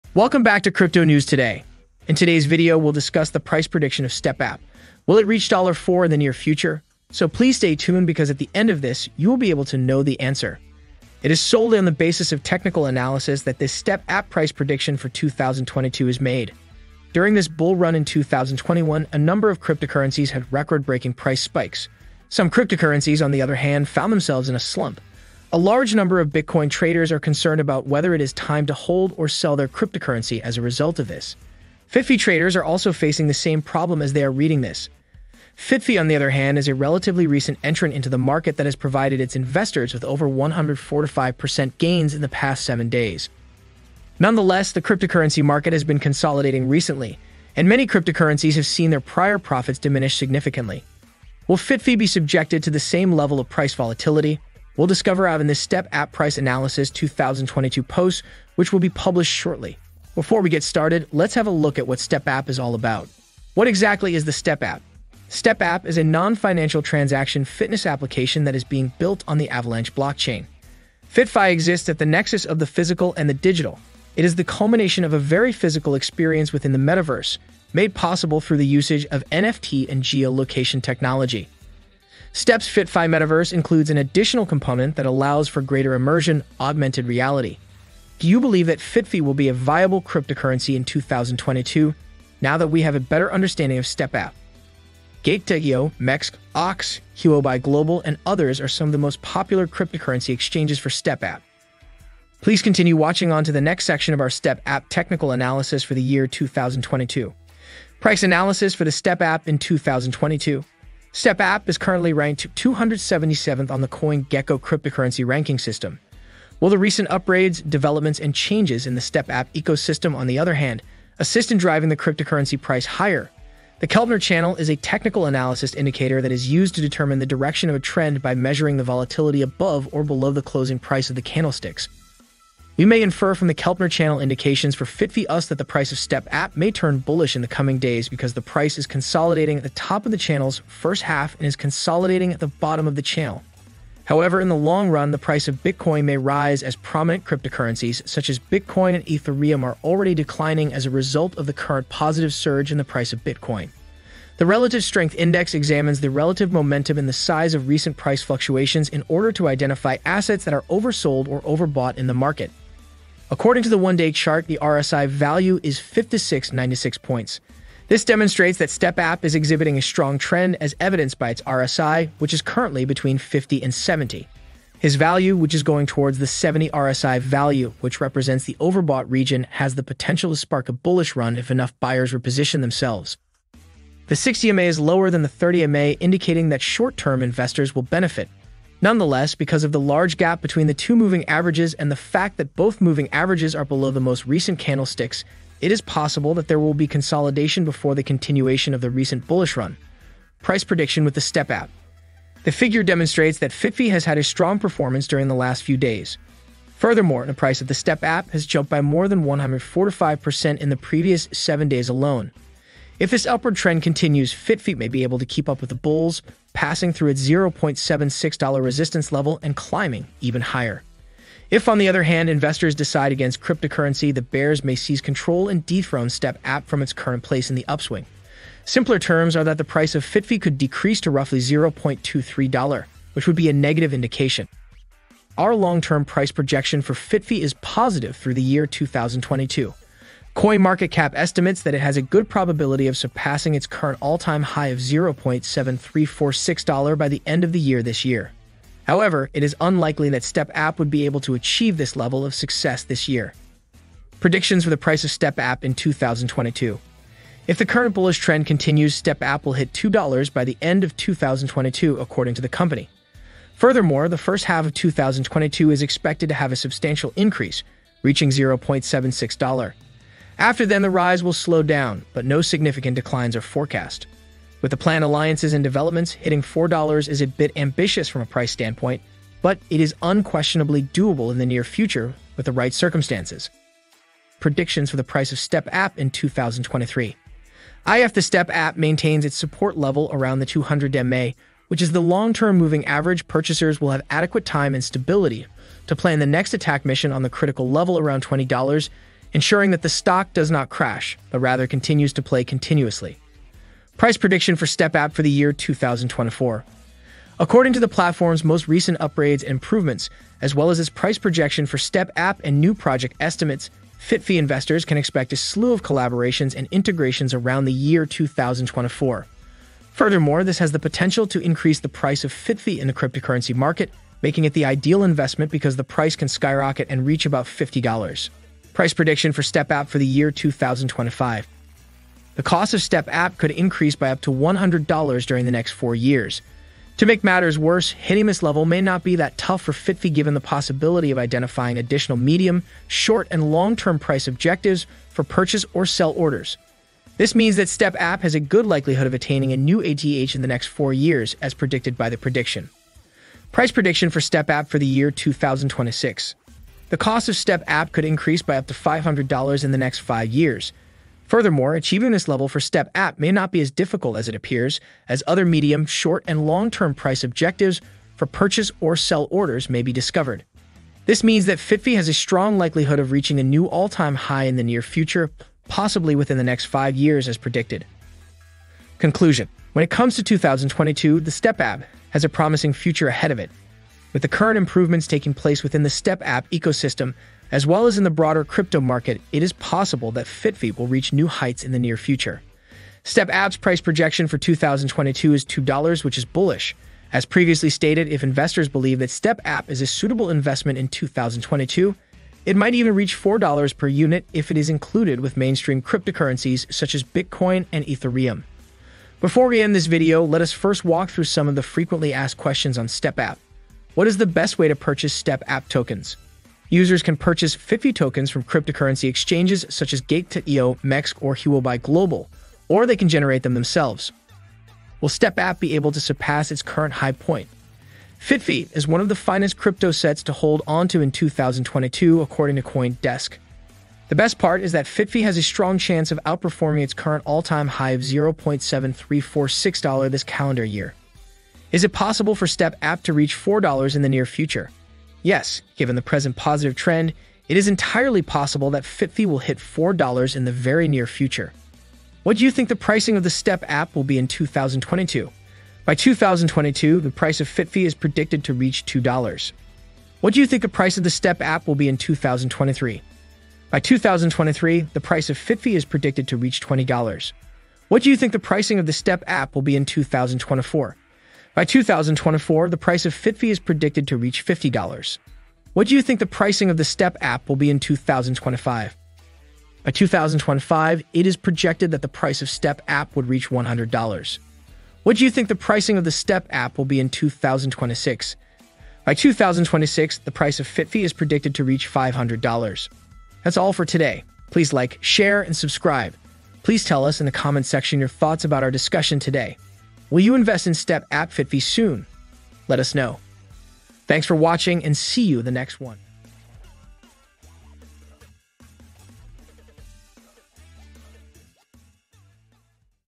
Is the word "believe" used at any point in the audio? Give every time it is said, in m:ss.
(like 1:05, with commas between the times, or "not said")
1:28, 6:38.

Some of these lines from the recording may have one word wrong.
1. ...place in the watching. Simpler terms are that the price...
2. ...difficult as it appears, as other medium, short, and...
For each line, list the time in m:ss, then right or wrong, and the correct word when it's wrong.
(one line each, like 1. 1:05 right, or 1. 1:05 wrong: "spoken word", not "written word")
1. 3:47 wrong: "upswing", not "watching"
2. 6:03 right.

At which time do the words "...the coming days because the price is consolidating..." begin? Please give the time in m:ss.
2:17.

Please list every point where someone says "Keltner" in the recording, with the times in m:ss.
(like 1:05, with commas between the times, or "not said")
2:03, 2:13.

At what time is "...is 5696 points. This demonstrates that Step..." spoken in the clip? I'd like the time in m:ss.
2:45.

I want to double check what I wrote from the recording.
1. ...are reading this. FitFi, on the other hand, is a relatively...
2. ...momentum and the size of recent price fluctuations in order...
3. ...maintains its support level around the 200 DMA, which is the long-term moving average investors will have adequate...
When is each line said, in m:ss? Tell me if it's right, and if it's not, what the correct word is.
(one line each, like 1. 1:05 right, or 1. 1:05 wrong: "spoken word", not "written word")
1. 0:34 right
2. 2:36 right
3. 4:48 wrong: "purchasers", not "investors".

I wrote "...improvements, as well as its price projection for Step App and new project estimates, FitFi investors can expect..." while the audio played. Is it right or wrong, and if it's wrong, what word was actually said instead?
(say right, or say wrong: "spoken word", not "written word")
right.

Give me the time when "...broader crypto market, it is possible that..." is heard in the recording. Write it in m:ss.
6:28.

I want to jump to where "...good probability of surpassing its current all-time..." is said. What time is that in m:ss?
4:02.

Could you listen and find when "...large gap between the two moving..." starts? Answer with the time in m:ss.
3:09.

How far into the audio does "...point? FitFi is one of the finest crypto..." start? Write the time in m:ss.
7:07.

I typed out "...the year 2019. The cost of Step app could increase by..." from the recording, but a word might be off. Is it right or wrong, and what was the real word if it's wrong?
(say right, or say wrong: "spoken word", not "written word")
wrong: "2026", not "2019".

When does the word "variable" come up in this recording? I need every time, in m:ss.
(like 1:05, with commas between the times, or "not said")
not said.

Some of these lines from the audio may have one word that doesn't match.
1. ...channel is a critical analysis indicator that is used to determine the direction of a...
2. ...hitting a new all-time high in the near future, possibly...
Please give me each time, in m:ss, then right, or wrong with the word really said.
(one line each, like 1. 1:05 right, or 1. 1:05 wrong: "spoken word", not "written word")
1. 2:04 wrong: "technical", not "critical"
2. 6:13 wrong: "reaching", not "hitting".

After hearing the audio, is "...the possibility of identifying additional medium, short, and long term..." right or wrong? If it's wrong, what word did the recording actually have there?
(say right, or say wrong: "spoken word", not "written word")
right.